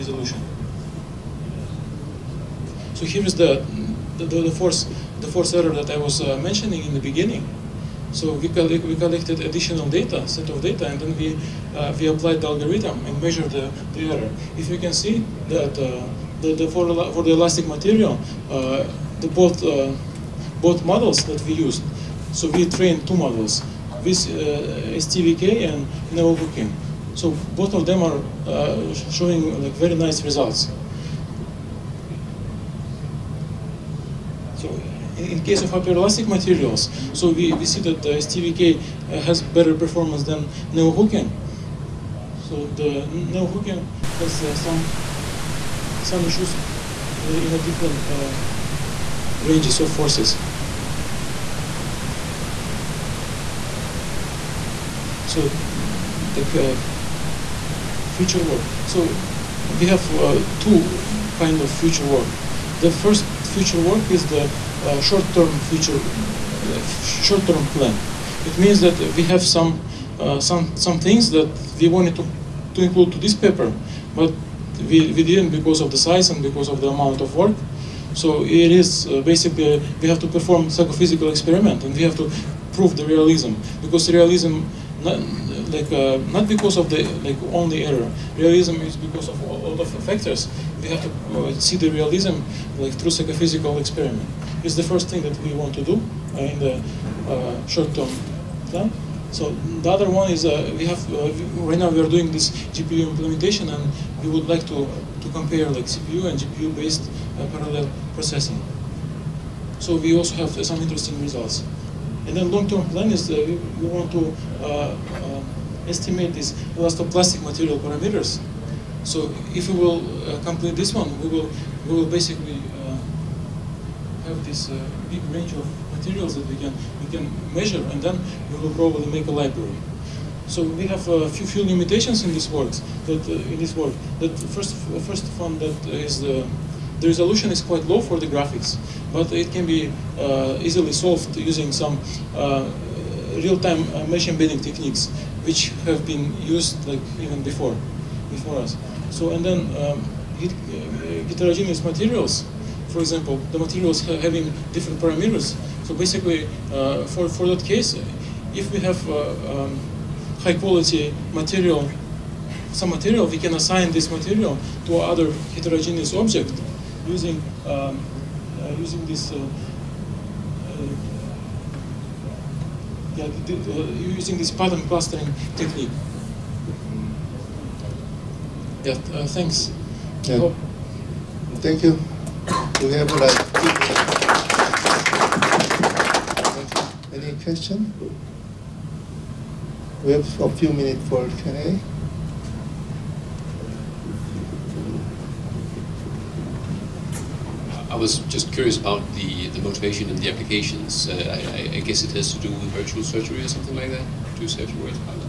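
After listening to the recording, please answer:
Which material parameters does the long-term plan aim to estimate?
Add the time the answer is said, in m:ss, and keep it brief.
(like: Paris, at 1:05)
Elastoplastic, at 1:56.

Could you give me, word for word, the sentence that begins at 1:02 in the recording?
The first future work is the uh, short-term future, short-term plan.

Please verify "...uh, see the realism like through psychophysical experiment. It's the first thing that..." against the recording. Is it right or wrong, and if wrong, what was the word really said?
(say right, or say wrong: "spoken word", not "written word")
right.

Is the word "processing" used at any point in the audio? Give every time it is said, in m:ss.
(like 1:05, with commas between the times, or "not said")
1:48.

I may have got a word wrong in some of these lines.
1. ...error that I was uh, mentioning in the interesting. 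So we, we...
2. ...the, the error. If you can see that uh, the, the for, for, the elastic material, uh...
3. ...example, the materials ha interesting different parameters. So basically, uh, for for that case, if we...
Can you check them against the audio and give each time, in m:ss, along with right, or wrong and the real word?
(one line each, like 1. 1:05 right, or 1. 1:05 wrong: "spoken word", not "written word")
1. 0:05 wrong: "beginning", not "interesting"
2. 0:13 right
3. 2:33 wrong: "having", not "interesting".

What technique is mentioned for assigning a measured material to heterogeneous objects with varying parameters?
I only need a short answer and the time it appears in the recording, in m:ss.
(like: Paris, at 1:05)
Pattern clustering, at 2:54.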